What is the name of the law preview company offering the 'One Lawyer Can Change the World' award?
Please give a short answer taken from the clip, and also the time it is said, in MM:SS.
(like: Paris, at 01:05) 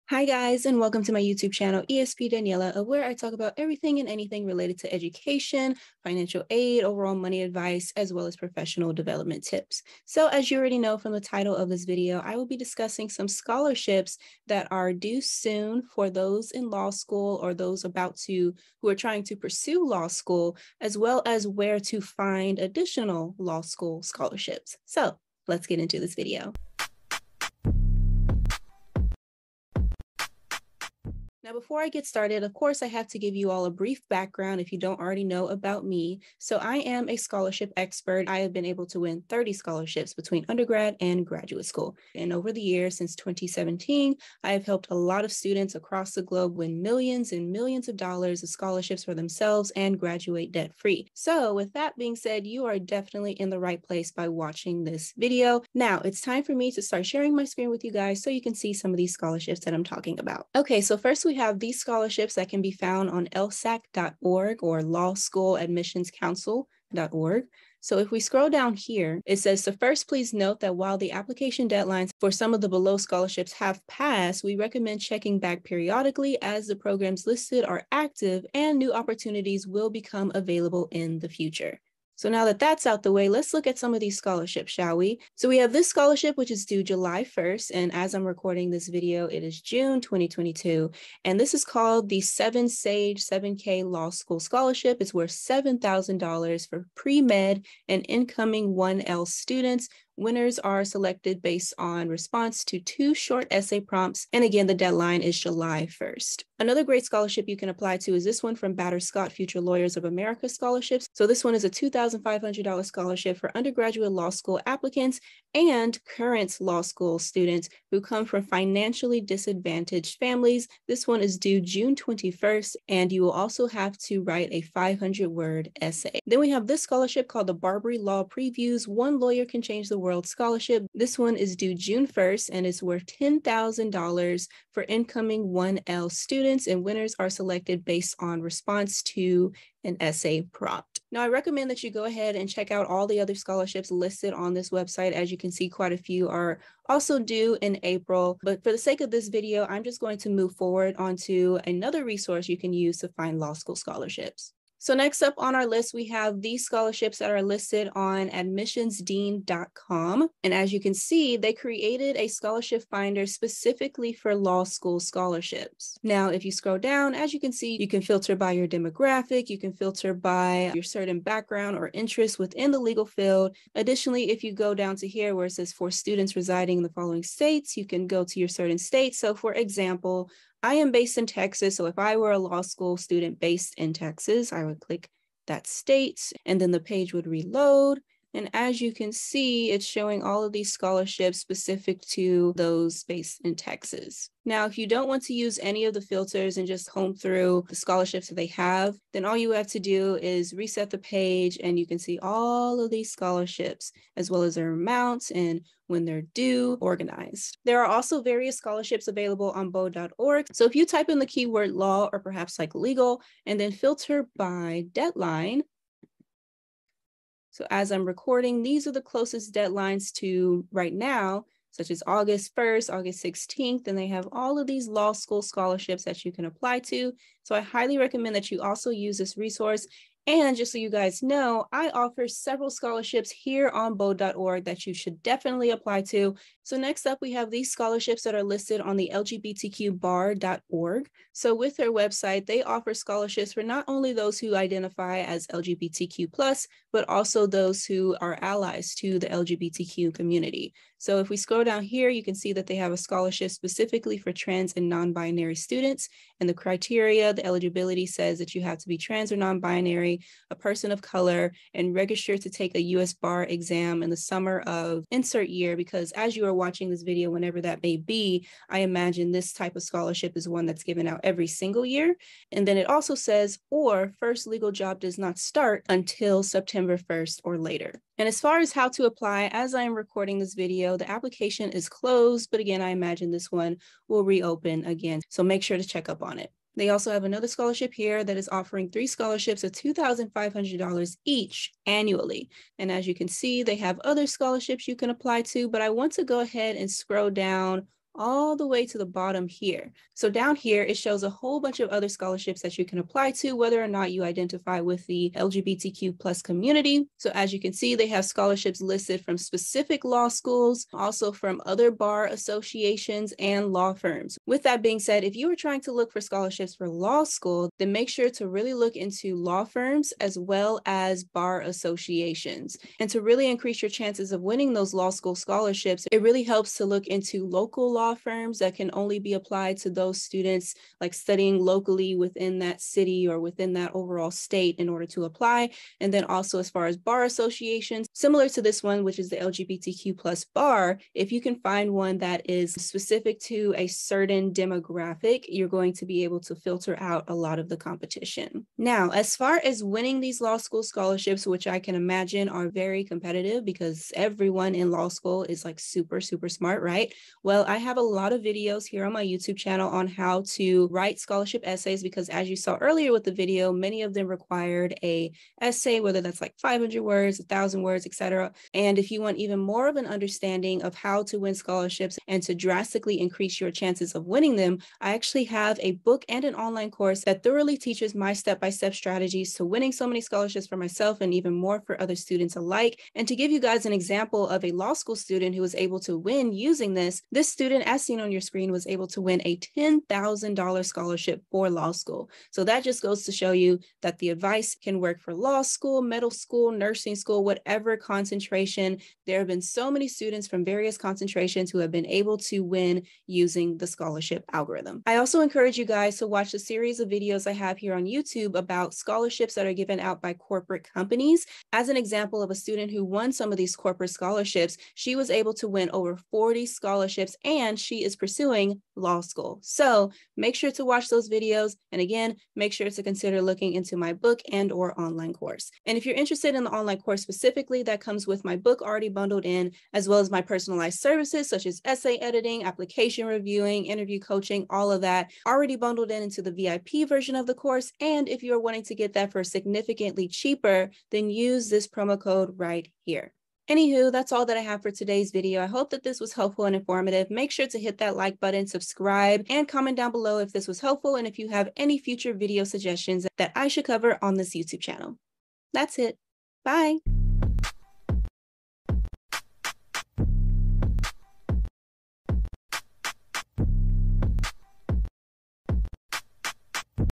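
BARBRI, at 02:07.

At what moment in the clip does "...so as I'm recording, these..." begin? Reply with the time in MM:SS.
03:37.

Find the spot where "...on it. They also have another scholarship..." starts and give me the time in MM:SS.
04:46.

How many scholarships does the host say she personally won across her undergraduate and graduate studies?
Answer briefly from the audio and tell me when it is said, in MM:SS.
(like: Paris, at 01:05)
30, at 00:39.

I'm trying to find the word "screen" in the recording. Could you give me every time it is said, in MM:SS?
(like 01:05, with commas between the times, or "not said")
00:57, 06:28.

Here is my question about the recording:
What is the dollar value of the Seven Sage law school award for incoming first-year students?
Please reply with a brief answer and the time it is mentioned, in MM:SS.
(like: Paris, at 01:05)
$7,000, at 01:35.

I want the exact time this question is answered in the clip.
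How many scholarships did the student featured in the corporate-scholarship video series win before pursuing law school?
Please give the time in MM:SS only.
06:55.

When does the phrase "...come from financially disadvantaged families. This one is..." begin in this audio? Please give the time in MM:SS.
01:57.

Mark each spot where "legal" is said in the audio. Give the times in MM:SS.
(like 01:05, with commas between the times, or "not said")
02:52, 03:32, 04:34.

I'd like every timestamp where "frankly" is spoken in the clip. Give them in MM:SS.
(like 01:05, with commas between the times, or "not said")
not said.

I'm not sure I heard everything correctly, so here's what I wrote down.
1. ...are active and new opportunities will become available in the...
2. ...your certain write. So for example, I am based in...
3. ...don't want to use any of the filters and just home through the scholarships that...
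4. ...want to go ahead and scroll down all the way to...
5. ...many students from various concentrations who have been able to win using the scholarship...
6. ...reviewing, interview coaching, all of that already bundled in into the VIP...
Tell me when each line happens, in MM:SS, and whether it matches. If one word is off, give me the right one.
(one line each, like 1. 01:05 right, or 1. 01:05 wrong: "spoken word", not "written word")
1. 01:17 right
2. 02:58 wrong: "state", not "write"
3. 03:14 right
4. 04:55 right
5. 06:39 right
6. 07:13 right.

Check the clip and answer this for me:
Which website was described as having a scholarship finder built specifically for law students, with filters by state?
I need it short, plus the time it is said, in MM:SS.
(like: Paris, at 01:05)
admissionsdean.com, at 02:38.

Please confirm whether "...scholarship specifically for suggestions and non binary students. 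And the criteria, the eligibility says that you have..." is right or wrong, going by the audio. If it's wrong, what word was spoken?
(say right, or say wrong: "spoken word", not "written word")
wrong: "trans", not "suggestions".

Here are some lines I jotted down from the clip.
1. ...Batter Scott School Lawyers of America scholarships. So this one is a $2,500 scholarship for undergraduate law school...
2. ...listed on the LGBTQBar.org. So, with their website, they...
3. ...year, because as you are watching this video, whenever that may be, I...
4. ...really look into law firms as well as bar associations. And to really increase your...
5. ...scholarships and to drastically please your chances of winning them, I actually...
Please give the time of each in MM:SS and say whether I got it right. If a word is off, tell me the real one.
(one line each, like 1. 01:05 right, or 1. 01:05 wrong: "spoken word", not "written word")
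1. 01:48 wrong: "Future", not "School"
2. 03:58 right
3. 04:25 right
4. 05:18 right
5. 06:11 wrong: "increase", not "please".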